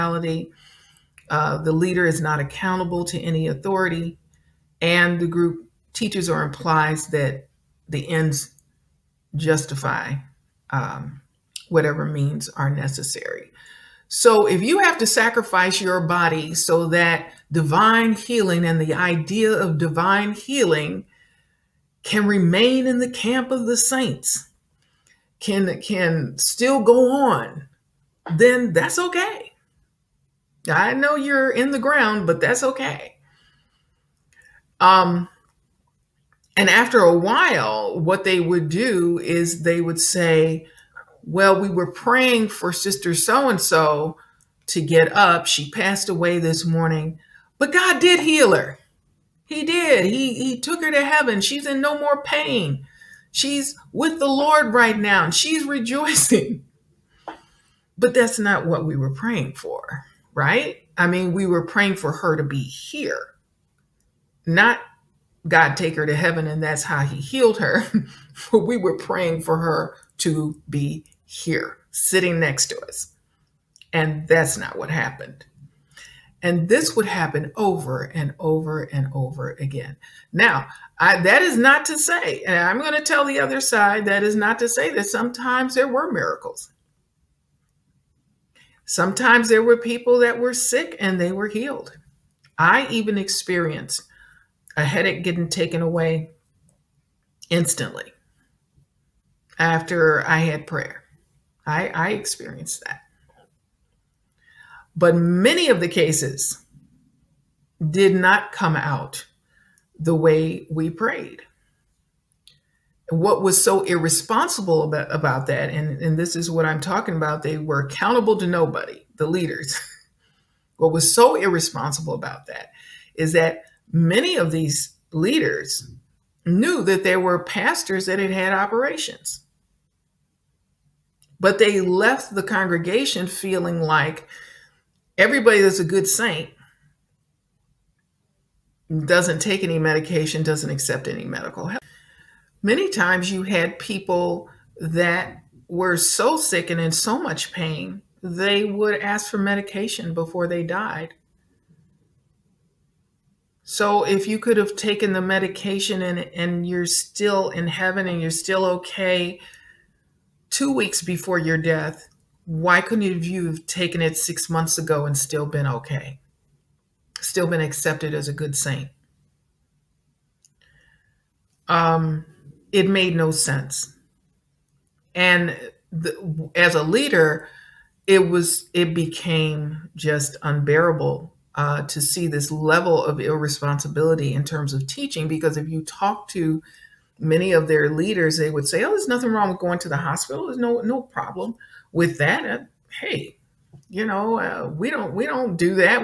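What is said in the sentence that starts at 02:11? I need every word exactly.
But they left the congregation feeling like everybody that's a good saint doesn't take any medication, doesn't accept any medical help.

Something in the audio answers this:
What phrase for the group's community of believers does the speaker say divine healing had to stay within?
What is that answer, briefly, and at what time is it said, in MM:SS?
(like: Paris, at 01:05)
the camp of the saints, at 00:23.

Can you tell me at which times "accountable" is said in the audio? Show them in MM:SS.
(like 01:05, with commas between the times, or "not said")
00:02, 01:57.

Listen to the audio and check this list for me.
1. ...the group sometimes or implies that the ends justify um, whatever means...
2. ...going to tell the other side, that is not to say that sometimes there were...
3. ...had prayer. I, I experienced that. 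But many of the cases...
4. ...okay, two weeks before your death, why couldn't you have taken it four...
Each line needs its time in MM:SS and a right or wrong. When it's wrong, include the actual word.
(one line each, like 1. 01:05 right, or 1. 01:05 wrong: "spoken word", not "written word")
1. 00:05 wrong: "teaches", not "sometimes"
2. 01:22 right
3. 01:40 right
4. 02:38 wrong: "six", not "four".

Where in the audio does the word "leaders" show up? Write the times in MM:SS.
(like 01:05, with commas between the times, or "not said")
00:01, 01:59, 02:05, 02:56, 03:07.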